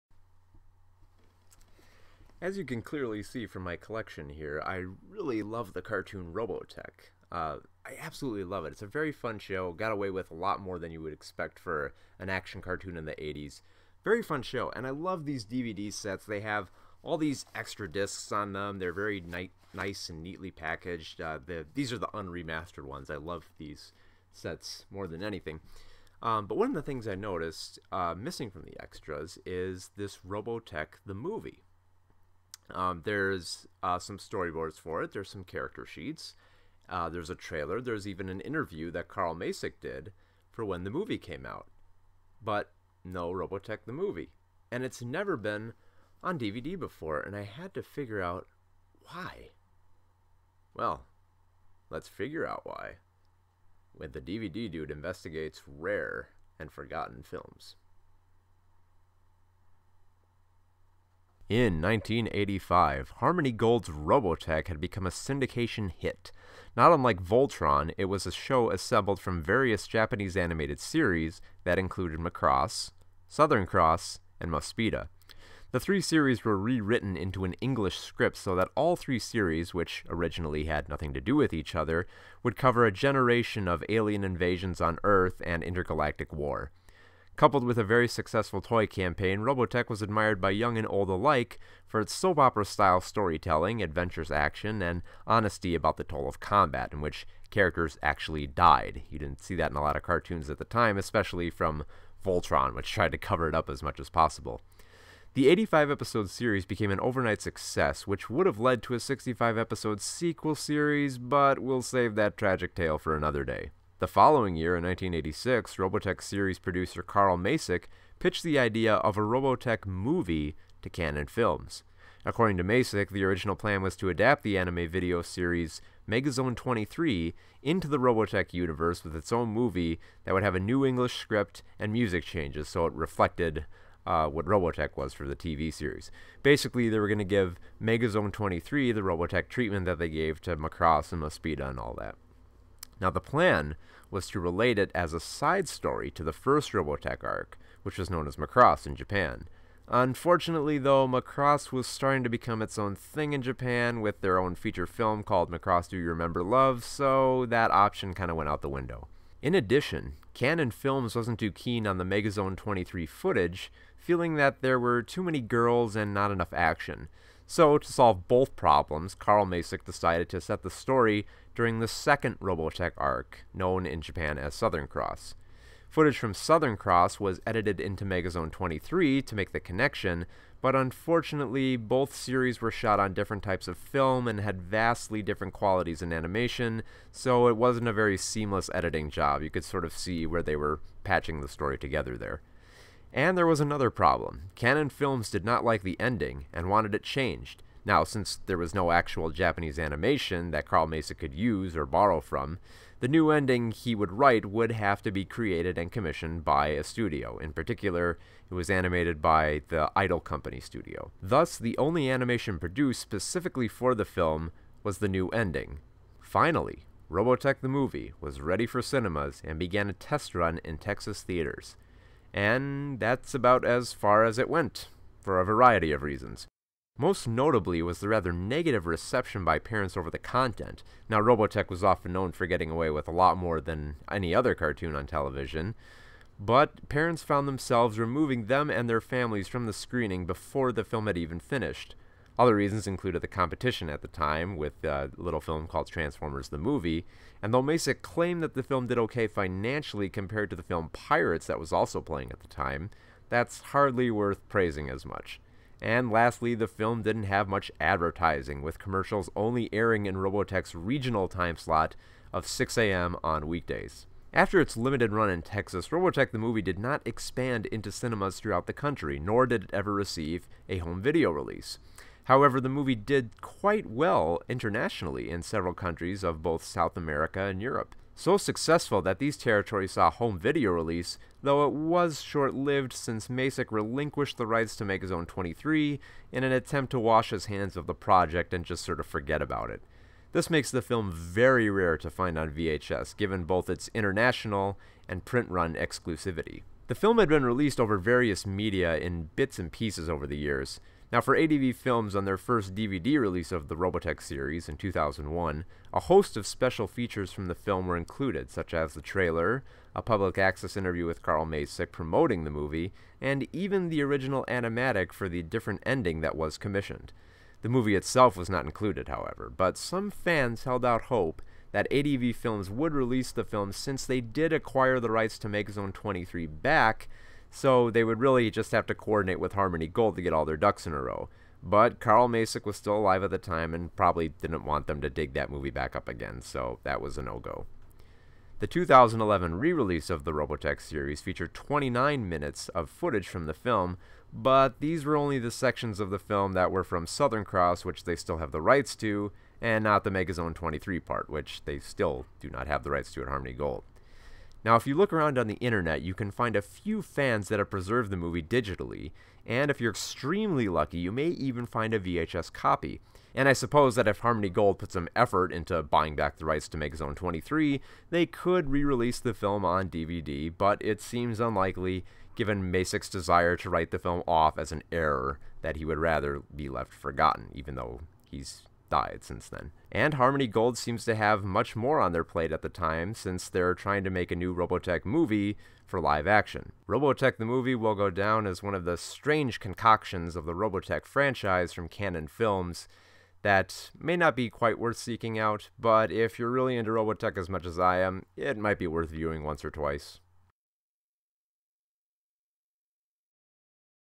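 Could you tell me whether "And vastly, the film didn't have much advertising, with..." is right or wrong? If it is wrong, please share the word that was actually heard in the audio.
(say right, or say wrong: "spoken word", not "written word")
wrong: "lastly", not "vastly".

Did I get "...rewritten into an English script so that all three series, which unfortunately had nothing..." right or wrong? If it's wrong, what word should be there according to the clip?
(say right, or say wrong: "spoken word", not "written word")
wrong: "originally", not "unfortunately".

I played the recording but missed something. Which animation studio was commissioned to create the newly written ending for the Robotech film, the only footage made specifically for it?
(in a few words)
Idol Company.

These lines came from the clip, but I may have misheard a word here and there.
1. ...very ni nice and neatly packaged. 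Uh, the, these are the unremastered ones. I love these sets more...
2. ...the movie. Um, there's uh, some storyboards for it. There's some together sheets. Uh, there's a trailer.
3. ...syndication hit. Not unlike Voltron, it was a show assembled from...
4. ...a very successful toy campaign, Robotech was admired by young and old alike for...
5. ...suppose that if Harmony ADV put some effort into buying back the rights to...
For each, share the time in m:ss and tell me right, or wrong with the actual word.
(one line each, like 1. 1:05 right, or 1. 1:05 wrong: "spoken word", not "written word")
1. 0:18 right
2. 0:31 wrong: "character", not "together"
3. 1:05 right
4. 1:27 right
5. 6:03 wrong: "Gold", not "ADV".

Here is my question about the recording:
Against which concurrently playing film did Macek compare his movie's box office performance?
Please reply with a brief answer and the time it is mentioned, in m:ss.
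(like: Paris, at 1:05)
Pirates, at 4:10.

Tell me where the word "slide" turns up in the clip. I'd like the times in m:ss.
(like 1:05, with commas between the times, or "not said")
not said.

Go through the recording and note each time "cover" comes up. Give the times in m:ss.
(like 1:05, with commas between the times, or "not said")
1:22, 1:43.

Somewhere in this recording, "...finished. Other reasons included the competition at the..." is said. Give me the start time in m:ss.
4:01.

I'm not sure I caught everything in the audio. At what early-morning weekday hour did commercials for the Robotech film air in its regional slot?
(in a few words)
6 a.m.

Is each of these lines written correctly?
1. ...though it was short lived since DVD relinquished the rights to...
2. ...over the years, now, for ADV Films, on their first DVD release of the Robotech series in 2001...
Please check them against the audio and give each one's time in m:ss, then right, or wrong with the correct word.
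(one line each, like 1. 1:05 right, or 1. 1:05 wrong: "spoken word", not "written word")
1. 4:41 wrong: "Macek", not "DVD"
2. 5:00 right.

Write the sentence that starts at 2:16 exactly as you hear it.
Basically, they were going to give Megazone 23 the Robotech treatment that they gave to Macross and Mospeada and all that.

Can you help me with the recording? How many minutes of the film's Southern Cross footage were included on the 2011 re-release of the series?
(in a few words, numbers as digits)
29.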